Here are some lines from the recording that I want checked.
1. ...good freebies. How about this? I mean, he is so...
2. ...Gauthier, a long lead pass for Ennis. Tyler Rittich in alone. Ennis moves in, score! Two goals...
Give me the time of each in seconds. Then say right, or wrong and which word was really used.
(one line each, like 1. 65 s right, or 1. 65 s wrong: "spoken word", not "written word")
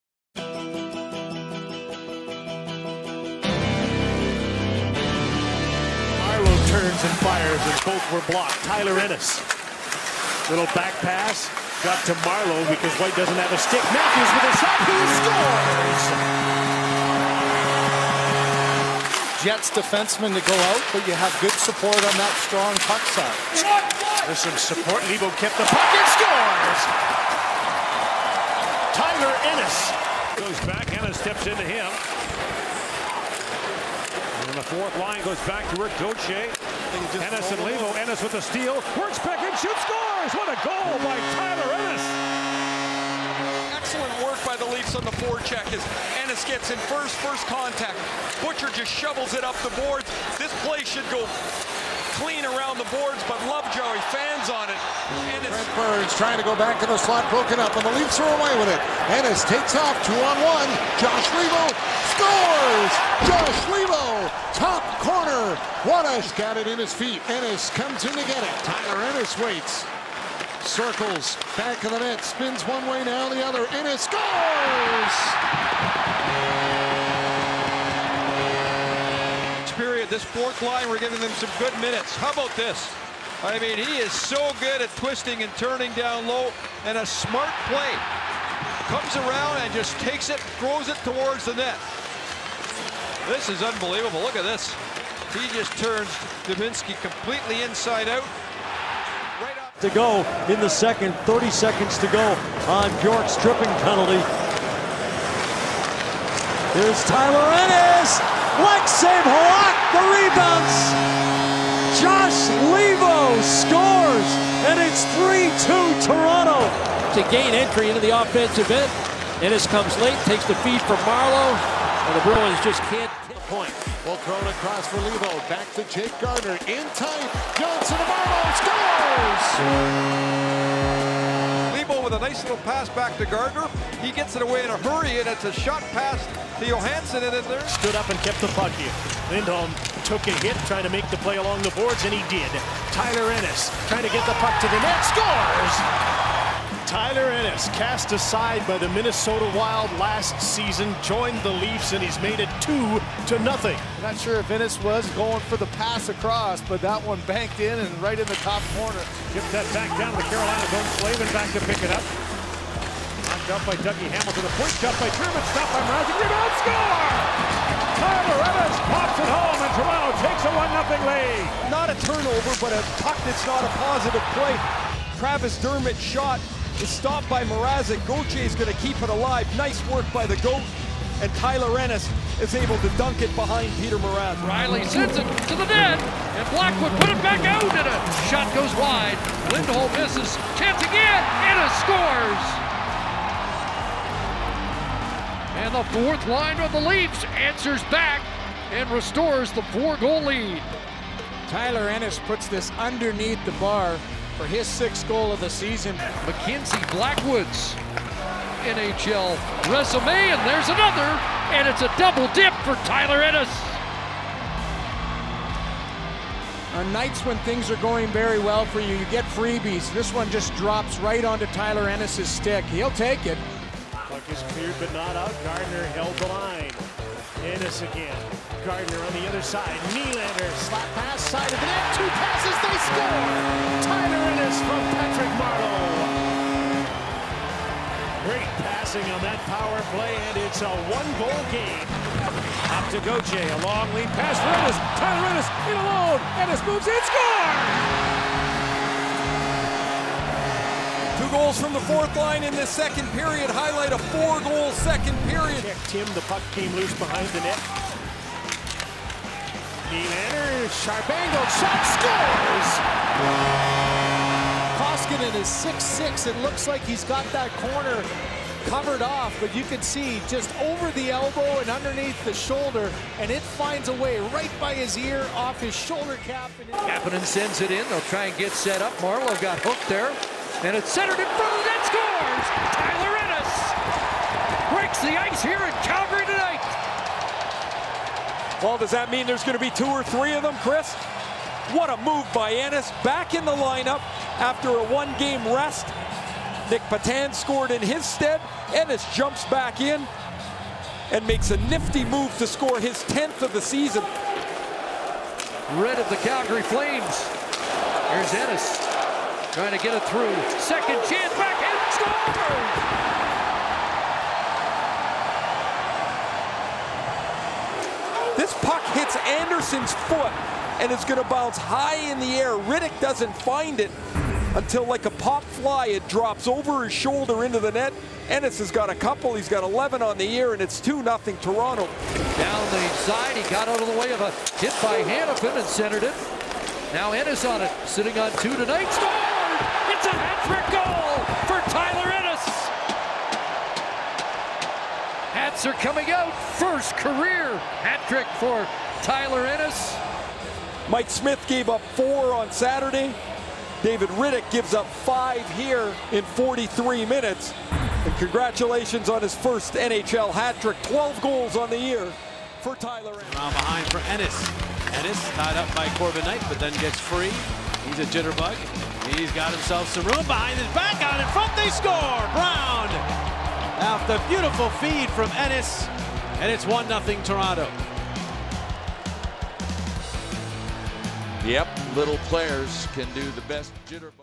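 1. 81 s wrong: "minutes", not "freebies"
2. 243 s wrong: "Ennis", not "Rittich".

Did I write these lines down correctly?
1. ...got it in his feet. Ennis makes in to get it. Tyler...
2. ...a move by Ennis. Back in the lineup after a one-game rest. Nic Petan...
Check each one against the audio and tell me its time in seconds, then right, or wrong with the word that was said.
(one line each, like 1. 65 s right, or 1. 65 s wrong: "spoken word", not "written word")
1. 66 s wrong: "comes", not "makes"
2. 291 s right.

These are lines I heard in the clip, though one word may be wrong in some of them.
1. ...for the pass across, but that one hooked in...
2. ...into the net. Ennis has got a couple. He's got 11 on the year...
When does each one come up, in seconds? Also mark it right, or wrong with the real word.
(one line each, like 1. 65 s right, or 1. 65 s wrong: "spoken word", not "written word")
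1. 155 s wrong: "banked", not "hooked"
2. 327 s right.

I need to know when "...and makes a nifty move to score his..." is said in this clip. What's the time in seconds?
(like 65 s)
301 s.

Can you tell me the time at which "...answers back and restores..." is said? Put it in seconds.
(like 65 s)
197 s.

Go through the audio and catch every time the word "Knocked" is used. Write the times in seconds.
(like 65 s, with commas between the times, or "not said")
163 s.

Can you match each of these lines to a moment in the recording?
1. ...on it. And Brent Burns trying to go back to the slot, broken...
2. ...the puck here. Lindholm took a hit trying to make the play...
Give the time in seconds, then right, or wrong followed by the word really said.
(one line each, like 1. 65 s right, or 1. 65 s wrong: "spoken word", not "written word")
1. 54 s right
2. 138 s right.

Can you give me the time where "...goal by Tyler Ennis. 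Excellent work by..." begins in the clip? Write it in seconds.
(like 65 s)
40 s.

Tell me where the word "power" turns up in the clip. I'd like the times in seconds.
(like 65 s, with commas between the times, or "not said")
239 s.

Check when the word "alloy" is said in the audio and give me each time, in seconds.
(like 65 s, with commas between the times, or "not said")
not said.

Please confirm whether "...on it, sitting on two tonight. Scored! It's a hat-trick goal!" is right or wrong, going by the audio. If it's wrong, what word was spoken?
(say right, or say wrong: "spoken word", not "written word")
right.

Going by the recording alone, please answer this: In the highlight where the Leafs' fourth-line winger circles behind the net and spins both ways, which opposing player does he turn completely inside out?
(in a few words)
Dubinsky.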